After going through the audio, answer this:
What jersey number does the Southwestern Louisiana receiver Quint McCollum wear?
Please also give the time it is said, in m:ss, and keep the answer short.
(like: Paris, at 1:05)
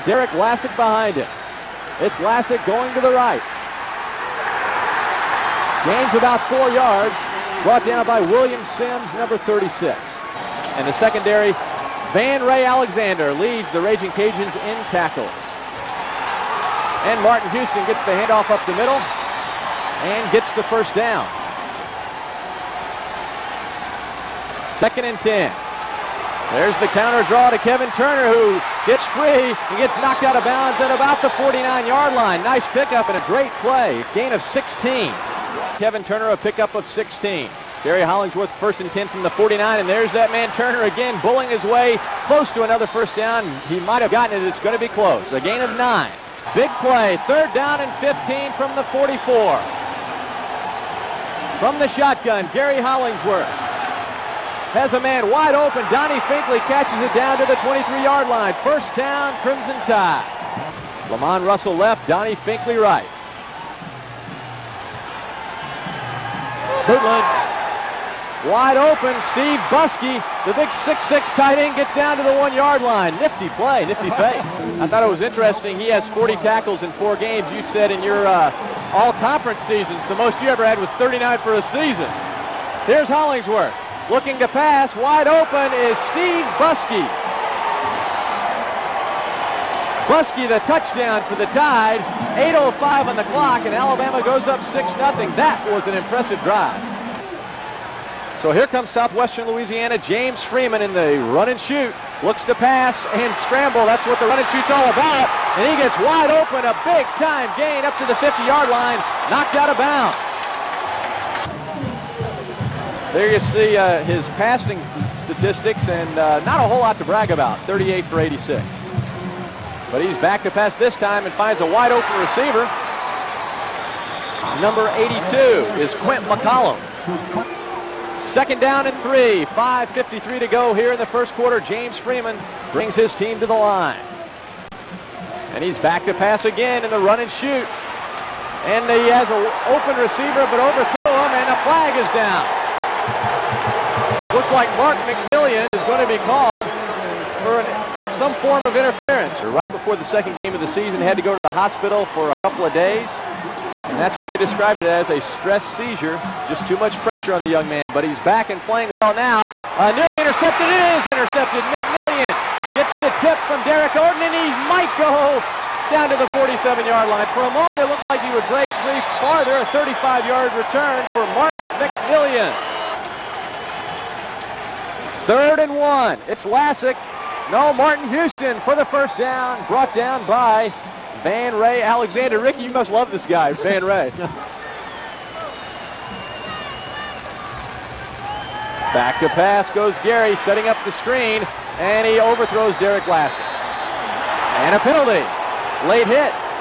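82, at 2:04.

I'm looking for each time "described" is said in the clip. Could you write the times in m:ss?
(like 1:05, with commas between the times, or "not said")
2:34.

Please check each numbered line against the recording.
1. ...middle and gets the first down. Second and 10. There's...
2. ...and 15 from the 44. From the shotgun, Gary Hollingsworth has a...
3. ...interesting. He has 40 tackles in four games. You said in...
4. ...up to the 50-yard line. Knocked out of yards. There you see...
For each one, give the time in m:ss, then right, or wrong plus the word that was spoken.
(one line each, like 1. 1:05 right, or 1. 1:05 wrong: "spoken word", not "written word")
1. 0:18 right
2. 0:47 right
3. 1:15 right
4. 1:47 wrong: "bounds", not "yards".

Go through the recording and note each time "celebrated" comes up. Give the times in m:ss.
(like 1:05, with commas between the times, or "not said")
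not said.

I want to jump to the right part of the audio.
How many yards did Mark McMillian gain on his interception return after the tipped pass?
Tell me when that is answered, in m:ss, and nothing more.
2:49.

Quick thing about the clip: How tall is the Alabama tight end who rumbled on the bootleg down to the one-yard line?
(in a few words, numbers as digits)
6-6.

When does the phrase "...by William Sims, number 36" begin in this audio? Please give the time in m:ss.
0:08.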